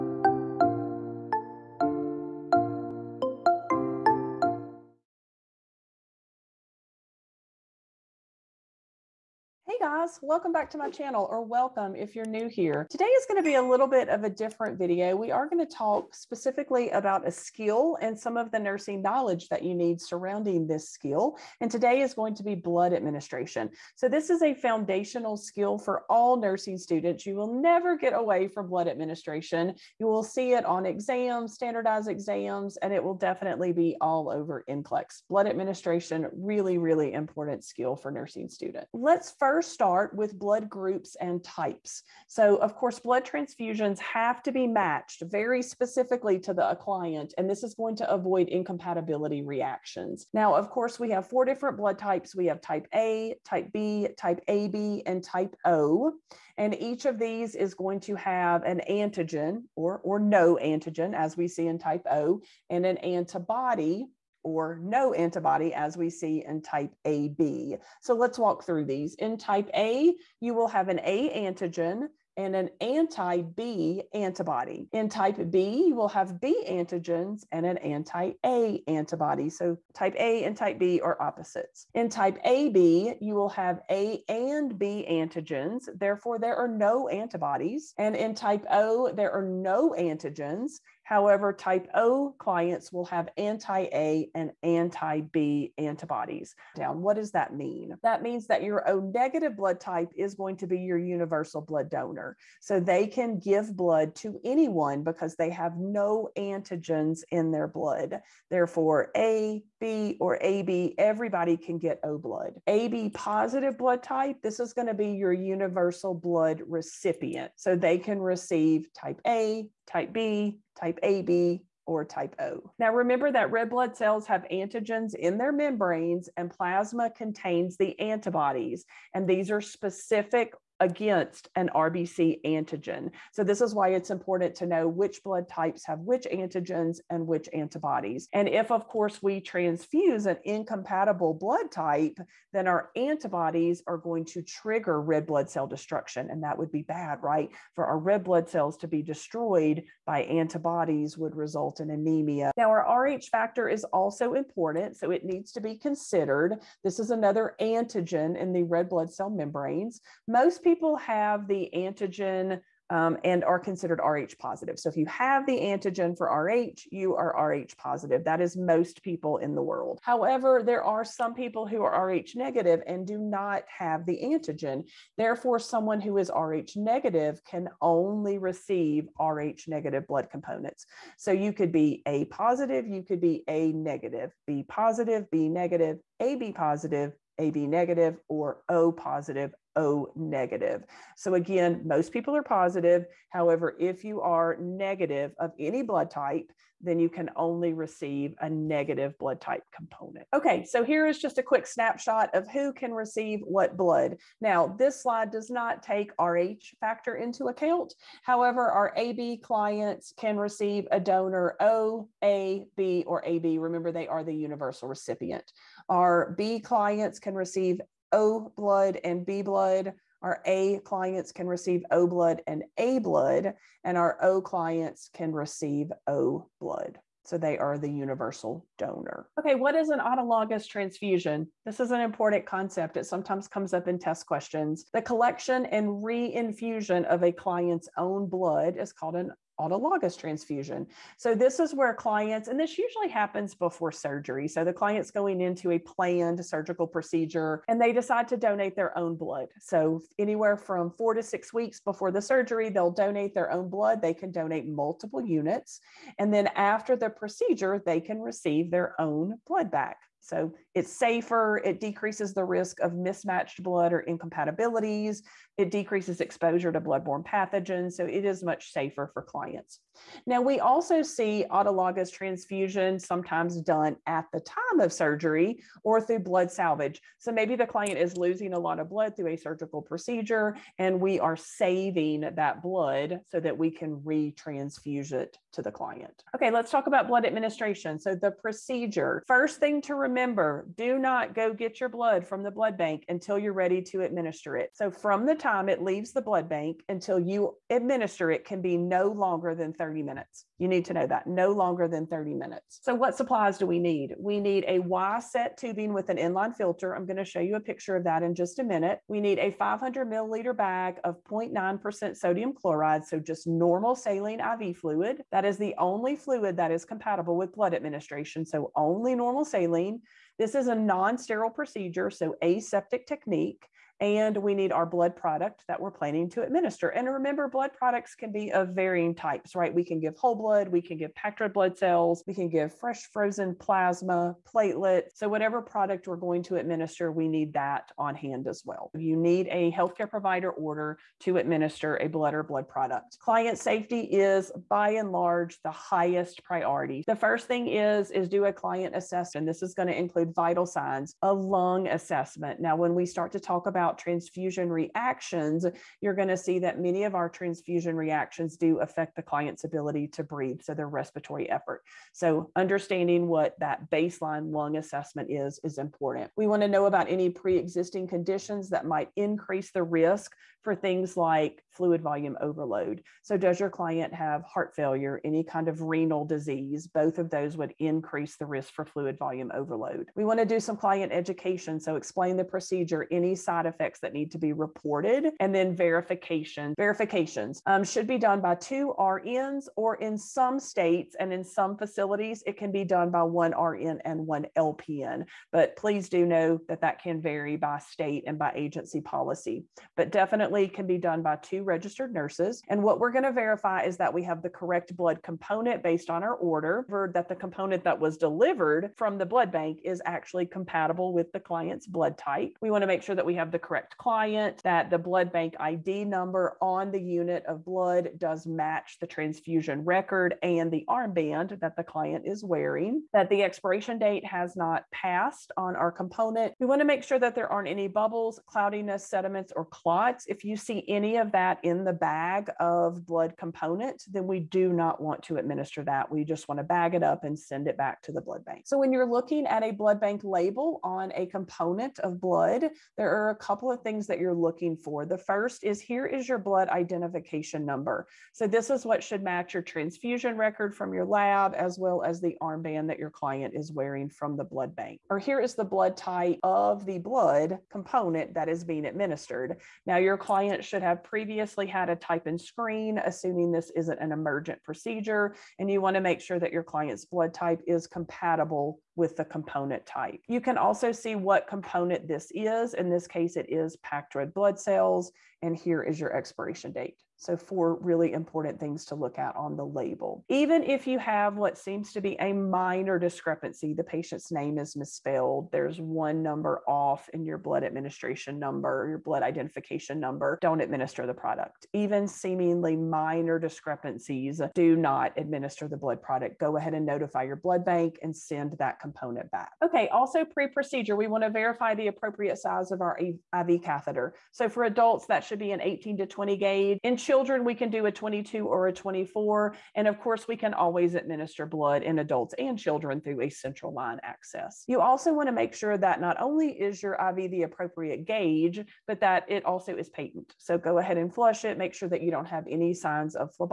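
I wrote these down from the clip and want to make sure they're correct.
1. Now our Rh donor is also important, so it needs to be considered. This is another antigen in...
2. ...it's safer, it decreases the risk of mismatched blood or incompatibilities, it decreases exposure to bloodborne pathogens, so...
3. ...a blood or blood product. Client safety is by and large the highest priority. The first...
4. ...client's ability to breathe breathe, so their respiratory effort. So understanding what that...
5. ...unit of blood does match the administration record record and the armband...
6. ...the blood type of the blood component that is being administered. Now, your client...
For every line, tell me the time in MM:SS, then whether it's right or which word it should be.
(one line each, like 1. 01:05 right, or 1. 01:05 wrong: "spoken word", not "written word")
1. 02:32 wrong: "factor", not "donor"
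2. 04:20 right
3. 05:41 right
4. 05:59 right
5. 06:57 wrong: "transfusion", not "administration"
6. 07:35 right.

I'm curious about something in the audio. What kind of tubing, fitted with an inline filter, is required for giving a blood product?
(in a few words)
Y set tubing.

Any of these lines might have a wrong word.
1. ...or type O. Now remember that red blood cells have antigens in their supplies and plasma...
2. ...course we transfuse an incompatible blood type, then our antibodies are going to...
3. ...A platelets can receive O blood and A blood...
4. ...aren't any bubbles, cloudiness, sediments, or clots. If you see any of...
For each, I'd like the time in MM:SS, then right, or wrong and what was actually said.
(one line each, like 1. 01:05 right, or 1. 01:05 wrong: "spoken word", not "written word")
1. 02:01 wrong: "membranes", not "supplies"
2. 02:18 right
3. 03:40 wrong: "clients", not "platelets"
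4. 07:07 right.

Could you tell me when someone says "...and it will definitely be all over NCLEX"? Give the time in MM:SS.
00:32.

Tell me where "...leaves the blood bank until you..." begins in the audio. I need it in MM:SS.
04:55.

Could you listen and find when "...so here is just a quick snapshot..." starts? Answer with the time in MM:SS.
03:20.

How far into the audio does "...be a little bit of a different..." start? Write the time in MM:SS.
00:13.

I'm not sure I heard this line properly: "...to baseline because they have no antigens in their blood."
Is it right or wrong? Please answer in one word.
wrong.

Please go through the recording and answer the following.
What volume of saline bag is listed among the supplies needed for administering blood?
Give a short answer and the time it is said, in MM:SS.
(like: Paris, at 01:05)
500 milliliters, at 05:09.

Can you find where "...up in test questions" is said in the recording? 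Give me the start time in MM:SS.
03:53.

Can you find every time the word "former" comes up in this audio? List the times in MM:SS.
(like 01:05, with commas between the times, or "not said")
not said.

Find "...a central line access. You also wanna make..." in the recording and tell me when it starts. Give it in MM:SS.
08:33.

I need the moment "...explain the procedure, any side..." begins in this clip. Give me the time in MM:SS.
06:21.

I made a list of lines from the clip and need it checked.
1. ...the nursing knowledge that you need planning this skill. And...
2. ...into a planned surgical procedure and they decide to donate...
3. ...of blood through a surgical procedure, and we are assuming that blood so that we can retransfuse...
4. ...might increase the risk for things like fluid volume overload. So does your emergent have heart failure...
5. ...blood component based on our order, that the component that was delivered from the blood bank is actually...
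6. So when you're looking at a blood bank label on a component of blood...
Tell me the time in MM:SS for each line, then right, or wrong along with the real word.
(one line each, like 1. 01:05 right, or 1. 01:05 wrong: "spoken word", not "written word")
1. 00:18 wrong: "surrounding", not "planning"
2. 04:05 right
3. 04:38 wrong: "saving", not "assuming"
4. 06:08 wrong: "client", not "emergent"
5. 06:44 right
6. 07:18 right.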